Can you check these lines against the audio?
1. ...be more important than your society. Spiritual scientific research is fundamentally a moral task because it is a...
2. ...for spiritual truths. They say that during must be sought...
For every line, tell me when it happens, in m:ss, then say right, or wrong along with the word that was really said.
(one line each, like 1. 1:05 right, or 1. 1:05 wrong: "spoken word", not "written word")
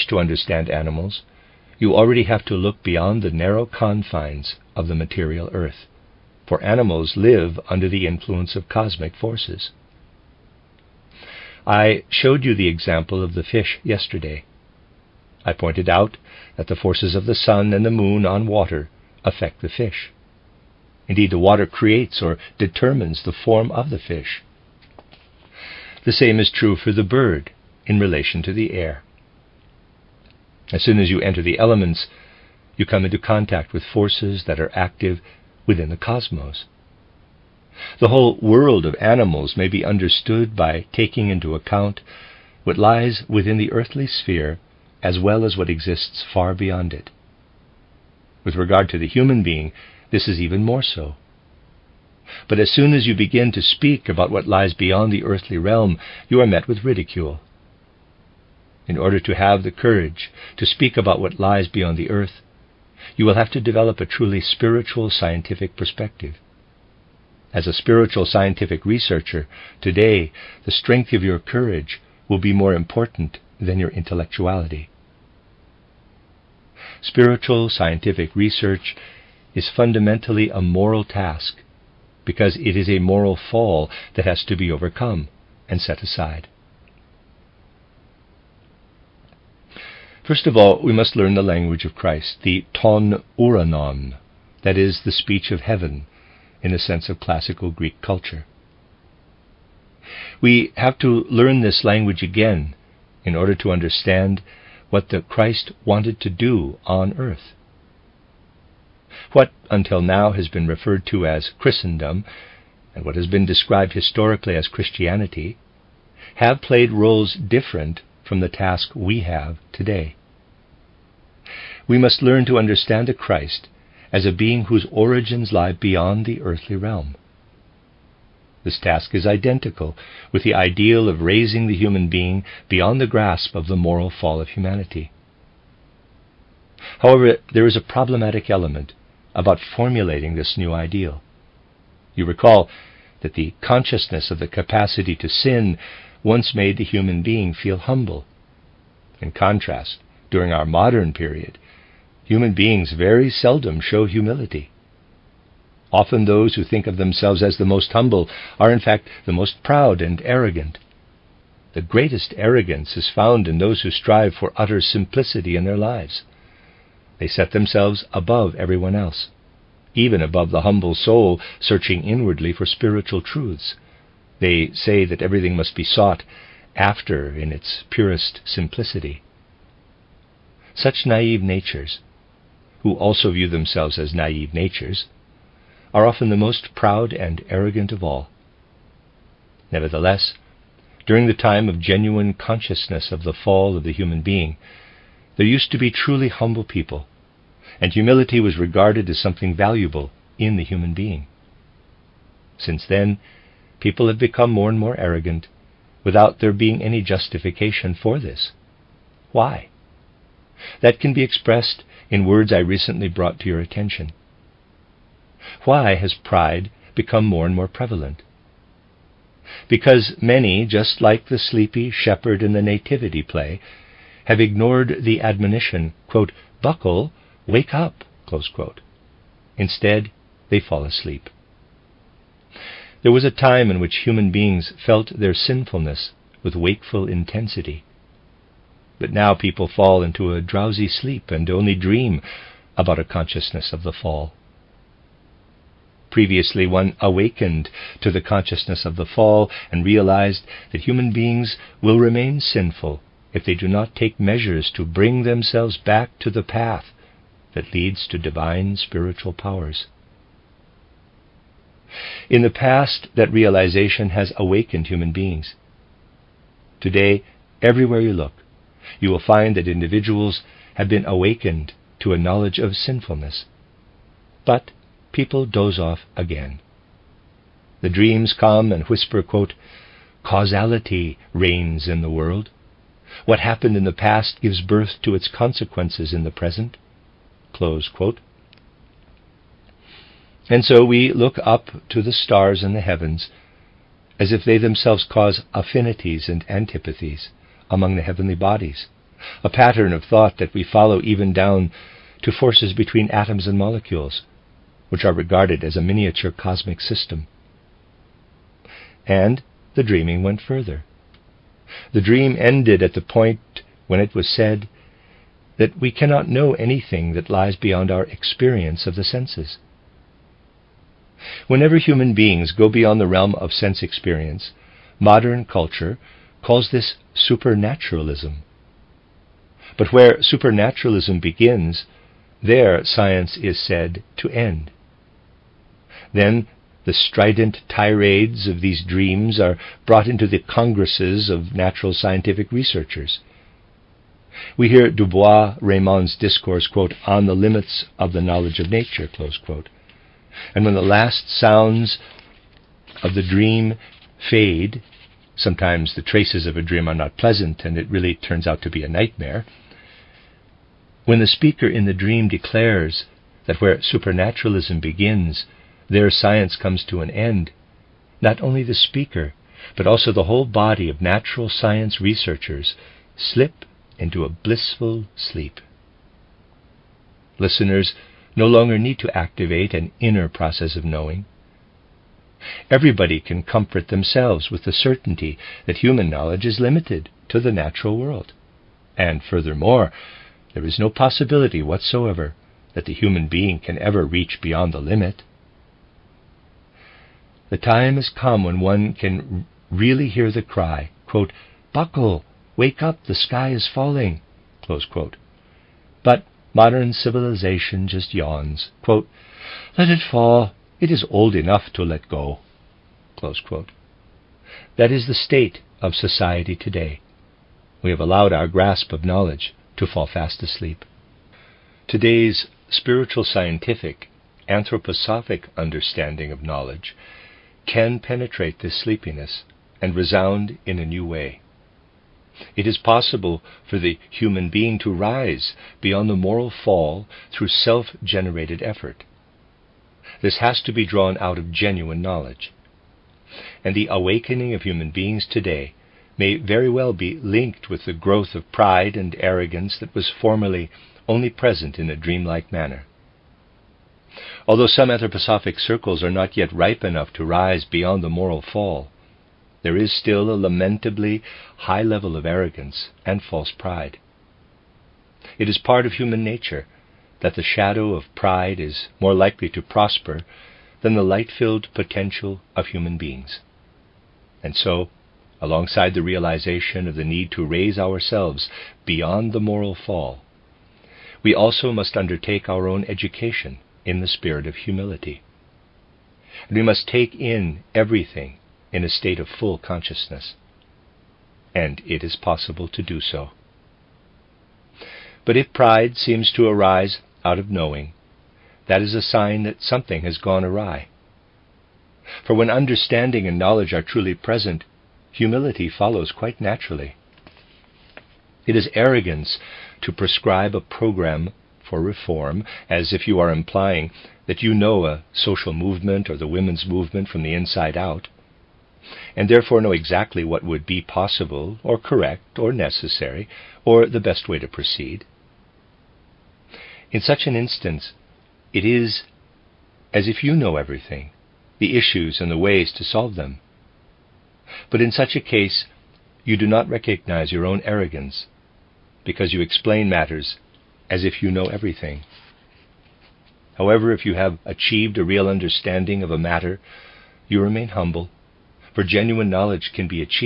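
1. 1:12 wrong: "intellectuality", not "society"
2. 2:52 wrong: "everything", not "during".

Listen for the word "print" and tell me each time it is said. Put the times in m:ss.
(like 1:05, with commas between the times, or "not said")
not said.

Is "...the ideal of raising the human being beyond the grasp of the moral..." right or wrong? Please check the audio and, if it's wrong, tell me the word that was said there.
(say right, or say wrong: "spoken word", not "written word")
right.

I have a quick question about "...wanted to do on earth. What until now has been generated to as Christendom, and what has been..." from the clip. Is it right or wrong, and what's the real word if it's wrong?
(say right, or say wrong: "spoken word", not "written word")
wrong: "referred", not "generated".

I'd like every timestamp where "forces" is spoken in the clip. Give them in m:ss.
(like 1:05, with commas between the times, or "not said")
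0:09, 0:16, 0:33, 5:02.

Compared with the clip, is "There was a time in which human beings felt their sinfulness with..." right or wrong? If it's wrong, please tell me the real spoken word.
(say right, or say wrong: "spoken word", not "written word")
right.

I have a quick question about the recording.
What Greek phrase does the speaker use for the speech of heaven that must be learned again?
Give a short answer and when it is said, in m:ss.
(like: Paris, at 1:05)
ton uranon, at 1:32.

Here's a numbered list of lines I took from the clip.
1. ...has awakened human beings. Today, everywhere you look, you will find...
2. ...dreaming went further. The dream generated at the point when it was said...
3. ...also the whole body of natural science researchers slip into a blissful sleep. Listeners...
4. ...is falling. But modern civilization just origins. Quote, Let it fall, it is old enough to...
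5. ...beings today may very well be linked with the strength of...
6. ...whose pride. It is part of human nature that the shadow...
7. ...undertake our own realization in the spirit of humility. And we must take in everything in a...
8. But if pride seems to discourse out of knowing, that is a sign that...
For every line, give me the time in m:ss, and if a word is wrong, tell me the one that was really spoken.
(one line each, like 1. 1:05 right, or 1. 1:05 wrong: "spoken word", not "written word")
1. 4:24 right
2. 5:09 wrong: "ended", not "generated"
3. 6:09 right
4. 6:43 wrong: "yawns", not "origins"
5. 7:24 wrong: "growth", not "strength"
6. 7:43 wrong: "false", not "whose"
7. 8:01 wrong: "education", not "realization"
8. 8:15 wrong: "arise", not "discourse".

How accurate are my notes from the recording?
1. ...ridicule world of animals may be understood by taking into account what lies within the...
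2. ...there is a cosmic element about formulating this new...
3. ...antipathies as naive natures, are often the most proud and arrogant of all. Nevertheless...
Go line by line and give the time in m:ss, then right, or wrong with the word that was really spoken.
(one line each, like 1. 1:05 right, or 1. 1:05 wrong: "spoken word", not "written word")
1. 0:38 wrong: "whole", not "ridicule"
2. 2:17 wrong: "problematic", not "cosmic"
3. 3:03 wrong: "themselves", not "antipathies".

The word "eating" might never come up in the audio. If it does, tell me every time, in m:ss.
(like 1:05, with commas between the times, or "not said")
not said.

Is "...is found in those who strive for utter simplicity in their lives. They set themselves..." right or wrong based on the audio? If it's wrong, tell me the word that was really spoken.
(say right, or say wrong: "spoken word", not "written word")
right.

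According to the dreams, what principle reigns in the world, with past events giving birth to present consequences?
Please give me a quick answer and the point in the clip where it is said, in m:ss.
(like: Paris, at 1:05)
causality, at 4:40.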